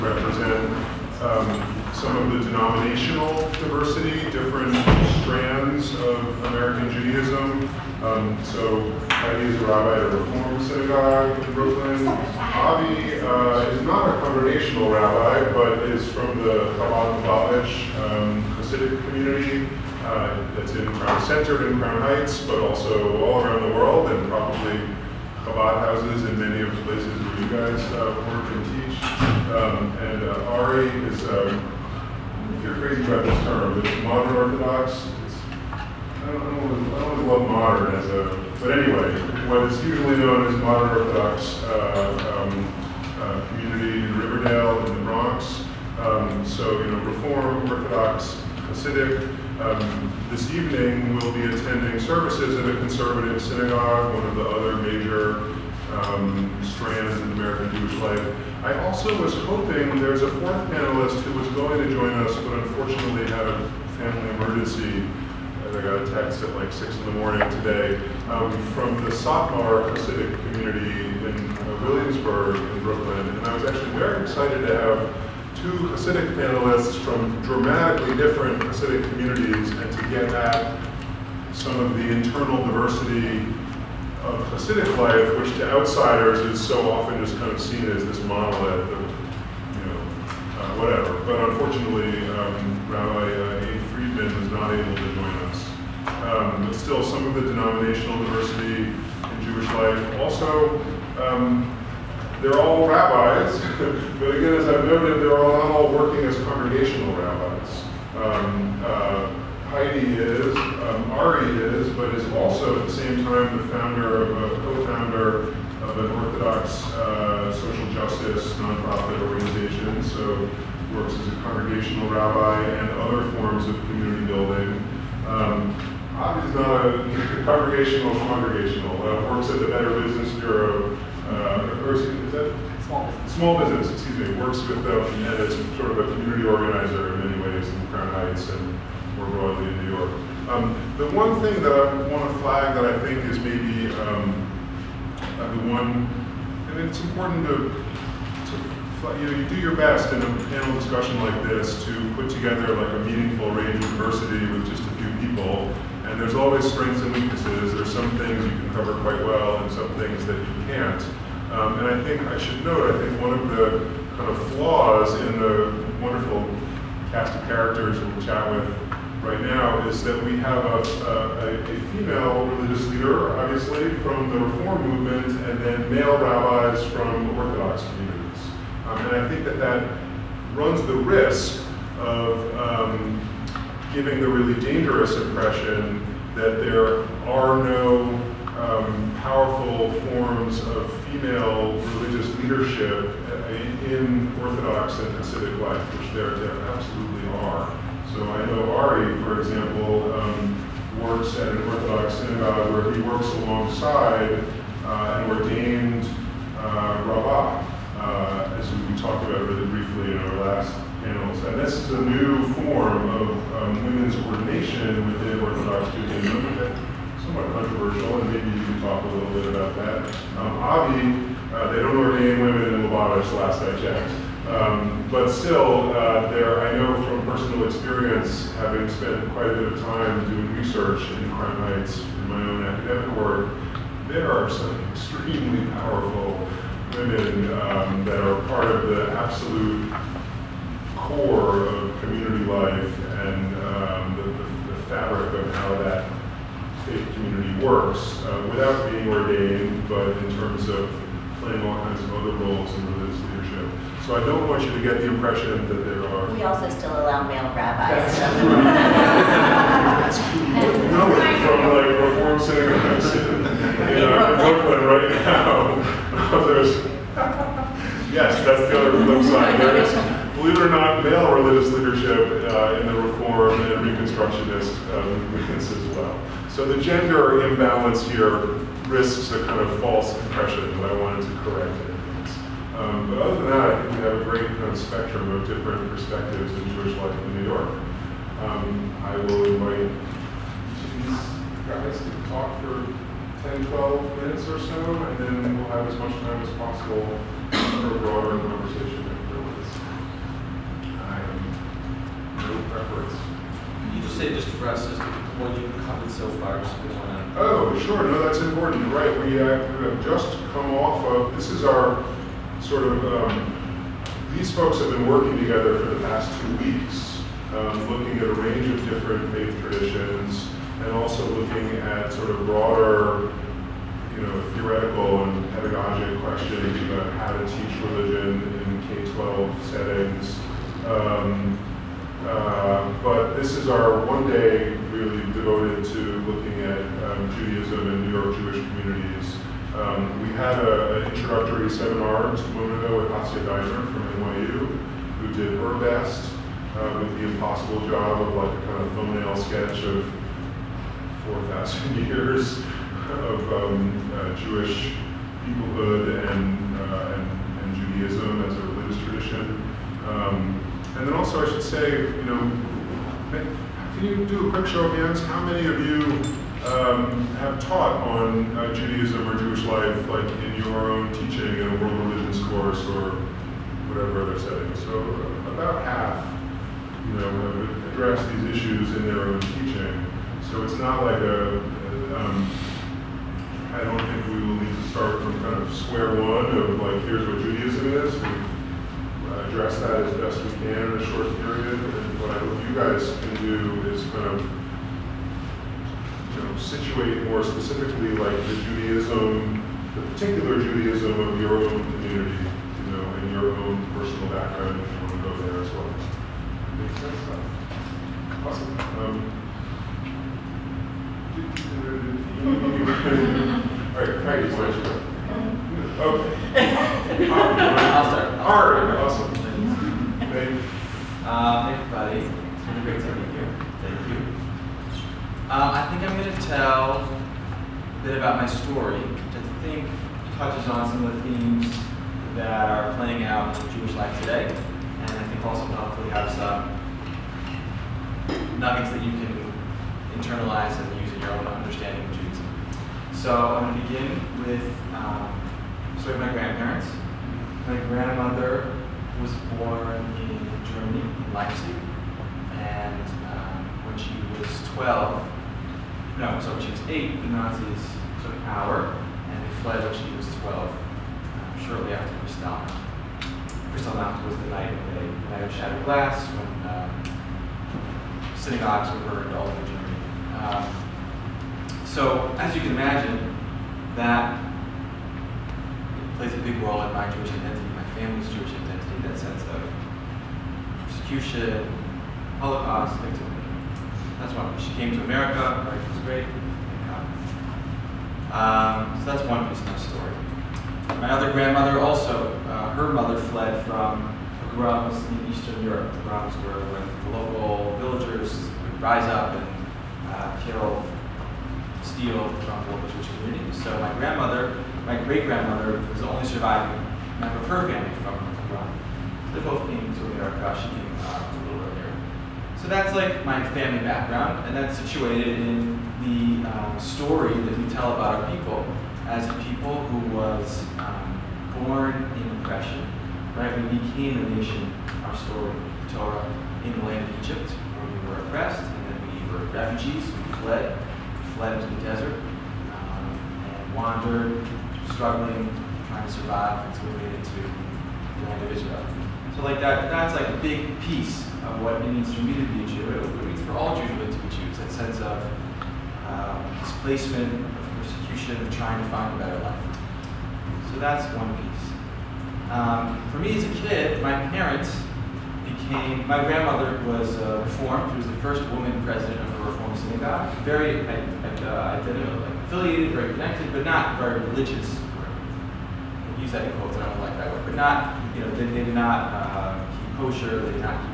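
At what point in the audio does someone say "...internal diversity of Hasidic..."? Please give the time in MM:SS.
01:22.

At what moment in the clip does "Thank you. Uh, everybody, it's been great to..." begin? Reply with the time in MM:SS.
06:59.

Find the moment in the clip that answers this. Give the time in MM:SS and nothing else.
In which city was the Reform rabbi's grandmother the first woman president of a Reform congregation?
09:19.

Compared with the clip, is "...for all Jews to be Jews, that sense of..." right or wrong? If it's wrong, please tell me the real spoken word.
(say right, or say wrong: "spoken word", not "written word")
right.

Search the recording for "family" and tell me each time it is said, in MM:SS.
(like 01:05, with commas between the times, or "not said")
01:03, 07:57, 08:27, 08:33.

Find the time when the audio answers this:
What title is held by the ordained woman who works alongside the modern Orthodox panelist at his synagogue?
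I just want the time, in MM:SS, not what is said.
03:27.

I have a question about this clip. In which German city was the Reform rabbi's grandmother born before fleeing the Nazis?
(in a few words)
Leipzig.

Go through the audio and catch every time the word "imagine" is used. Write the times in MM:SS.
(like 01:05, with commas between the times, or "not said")
07:52.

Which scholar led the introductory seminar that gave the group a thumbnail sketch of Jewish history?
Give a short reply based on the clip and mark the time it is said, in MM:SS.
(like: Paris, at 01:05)
Hasia Diner, at 05:43.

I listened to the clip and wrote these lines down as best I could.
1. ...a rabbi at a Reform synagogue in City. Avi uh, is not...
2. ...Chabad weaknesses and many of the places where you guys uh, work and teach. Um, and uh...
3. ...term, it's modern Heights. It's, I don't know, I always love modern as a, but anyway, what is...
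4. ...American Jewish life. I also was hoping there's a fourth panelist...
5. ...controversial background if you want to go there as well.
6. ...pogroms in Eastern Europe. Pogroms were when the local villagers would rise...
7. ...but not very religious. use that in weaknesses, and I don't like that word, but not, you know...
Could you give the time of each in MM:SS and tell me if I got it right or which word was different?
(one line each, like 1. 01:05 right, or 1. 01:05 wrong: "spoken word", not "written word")
1. 00:09 wrong: "Brooklyn", not "City"
2. 00:25 wrong: "houses", not "weaknesses"
3. 00:33 wrong: "Orthodox", not "Heights"
4. 00:57 right
5. 06:43 wrong: "personal", not "controversial"
6. 08:14 right
7. 09:23 wrong: "quotes", not "weaknesses".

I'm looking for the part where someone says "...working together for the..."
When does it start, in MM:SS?
05:15.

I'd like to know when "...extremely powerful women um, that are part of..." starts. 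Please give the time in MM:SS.
03:54.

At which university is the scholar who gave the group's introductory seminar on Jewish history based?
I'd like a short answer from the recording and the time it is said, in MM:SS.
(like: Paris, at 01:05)
NYU, at 05:44.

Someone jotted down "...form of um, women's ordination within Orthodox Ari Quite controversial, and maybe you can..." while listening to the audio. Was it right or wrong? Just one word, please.
wrong.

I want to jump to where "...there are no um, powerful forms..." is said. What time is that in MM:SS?
03:06.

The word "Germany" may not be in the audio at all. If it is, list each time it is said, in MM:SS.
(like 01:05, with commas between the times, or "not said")
07:30, 07:49.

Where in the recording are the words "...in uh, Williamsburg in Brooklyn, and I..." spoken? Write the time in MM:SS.
01:10.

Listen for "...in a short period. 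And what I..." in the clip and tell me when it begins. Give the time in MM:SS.
06:30.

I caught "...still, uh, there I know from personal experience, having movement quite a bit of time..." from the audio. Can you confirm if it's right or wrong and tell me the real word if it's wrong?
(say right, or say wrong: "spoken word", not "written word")
wrong: "spent", not "movement".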